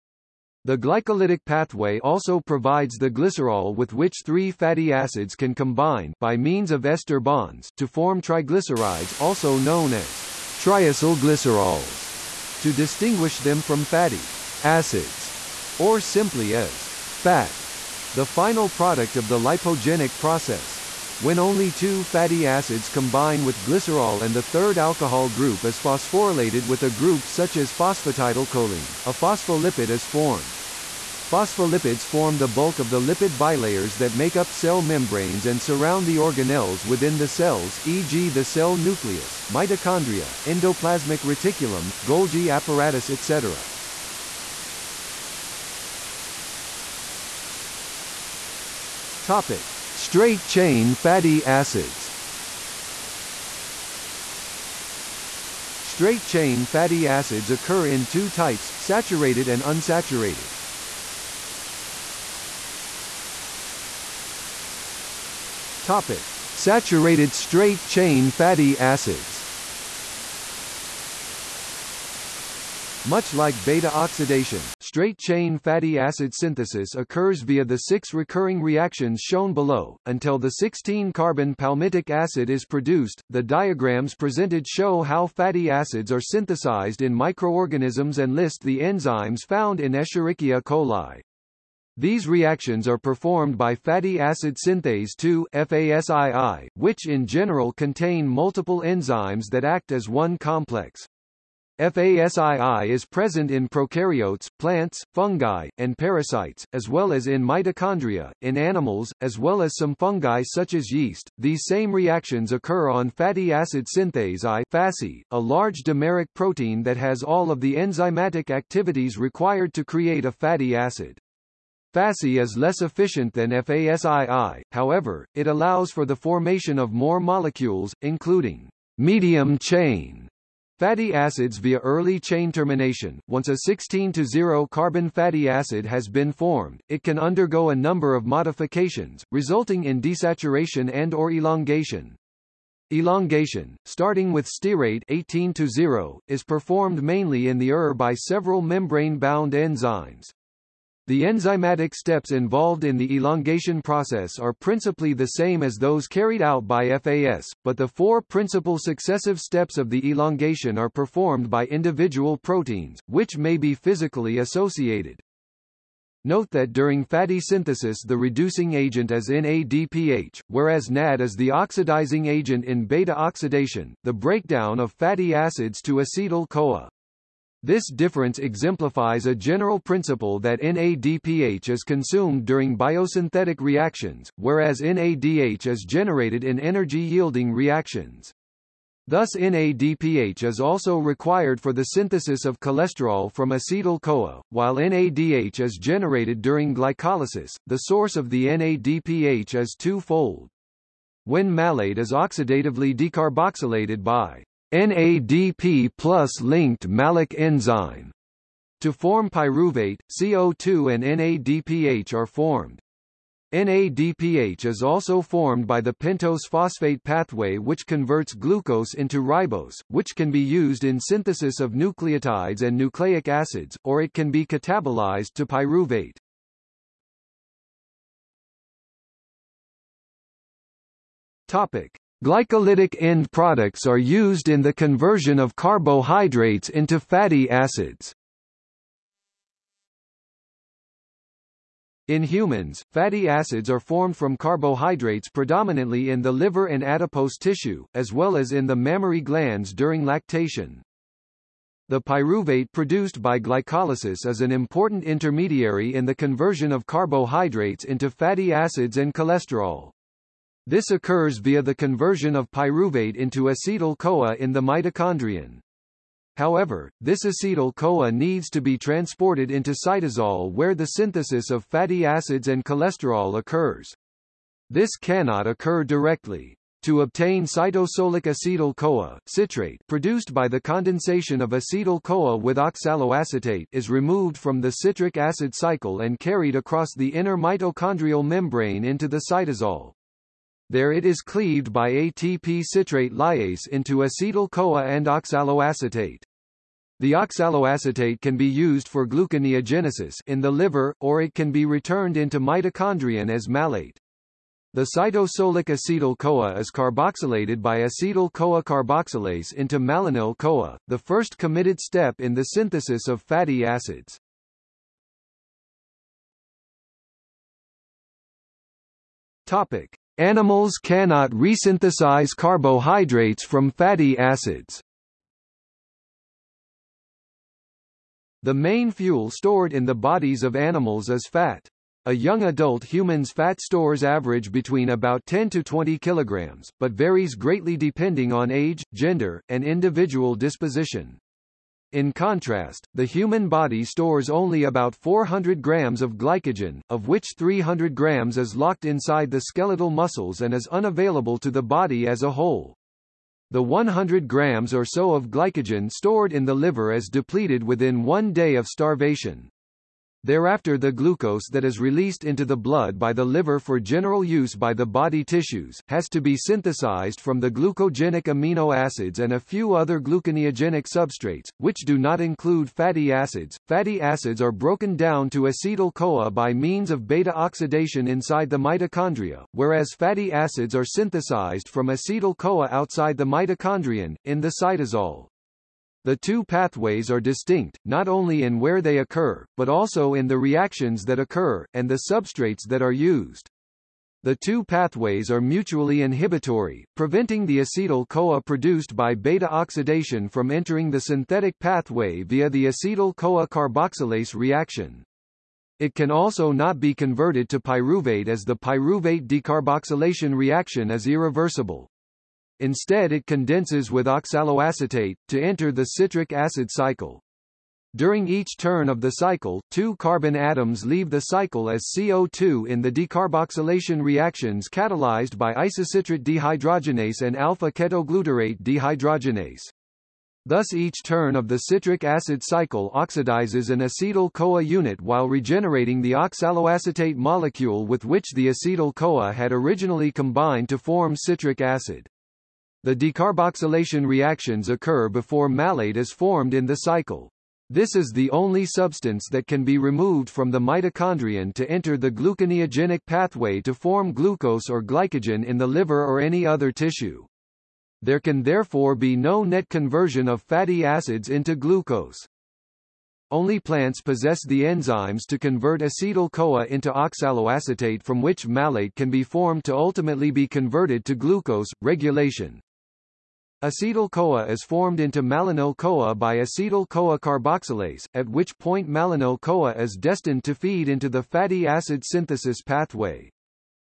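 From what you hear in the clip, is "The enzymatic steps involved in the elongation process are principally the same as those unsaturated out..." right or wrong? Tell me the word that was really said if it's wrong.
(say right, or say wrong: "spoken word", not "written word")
wrong: "carried", not "unsaturated".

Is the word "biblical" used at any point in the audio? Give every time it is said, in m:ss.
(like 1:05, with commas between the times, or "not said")
not said.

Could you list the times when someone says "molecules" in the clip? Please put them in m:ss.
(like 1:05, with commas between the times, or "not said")
2:07, 7:17.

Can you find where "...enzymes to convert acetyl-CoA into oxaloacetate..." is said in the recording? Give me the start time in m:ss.
7:44.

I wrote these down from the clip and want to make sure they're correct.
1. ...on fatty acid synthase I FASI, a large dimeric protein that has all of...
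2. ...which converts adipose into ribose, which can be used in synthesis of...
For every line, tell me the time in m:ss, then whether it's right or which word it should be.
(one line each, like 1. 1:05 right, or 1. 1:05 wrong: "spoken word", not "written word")
1. 1:52 right
2. 3:37 wrong: "glucose", not "adipose".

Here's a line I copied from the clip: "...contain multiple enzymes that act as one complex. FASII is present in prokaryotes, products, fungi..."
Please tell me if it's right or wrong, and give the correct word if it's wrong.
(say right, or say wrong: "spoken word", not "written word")
wrong: "plants", not "products".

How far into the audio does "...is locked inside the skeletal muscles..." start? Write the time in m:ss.
5:48.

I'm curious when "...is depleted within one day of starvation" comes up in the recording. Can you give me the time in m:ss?
5:56.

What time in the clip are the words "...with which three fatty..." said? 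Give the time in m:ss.
0:03.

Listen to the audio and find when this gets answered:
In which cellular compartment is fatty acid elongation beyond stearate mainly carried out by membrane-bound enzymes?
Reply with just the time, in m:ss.
2:27.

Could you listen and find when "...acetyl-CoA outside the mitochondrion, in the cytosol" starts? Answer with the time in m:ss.
6:21.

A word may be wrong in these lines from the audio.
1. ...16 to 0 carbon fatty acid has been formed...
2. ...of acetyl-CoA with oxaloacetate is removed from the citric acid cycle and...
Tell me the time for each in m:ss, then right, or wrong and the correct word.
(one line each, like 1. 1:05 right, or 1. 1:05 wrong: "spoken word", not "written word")
1. 2:13 right
2. 4:41 right.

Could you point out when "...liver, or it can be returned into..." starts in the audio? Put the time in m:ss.
5:00.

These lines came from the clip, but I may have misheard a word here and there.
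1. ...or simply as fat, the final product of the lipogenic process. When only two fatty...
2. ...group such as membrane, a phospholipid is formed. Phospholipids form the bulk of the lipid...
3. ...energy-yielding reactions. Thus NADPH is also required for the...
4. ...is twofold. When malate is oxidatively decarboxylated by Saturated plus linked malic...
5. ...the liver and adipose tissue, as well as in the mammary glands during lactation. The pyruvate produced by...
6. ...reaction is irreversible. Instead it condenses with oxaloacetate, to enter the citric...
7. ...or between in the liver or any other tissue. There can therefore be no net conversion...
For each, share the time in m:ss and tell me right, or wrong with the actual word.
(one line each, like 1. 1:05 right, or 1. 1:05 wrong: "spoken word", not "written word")
1. 0:15 right
2. 0:26 wrong: "phosphatidylcholine", not "membrane"
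3. 3:06 right
4. 3:19 wrong: "NADP", not "Saturated"
5. 4:06 right
6. 6:50 right
7. 7:34 wrong: "glycogen", not "between".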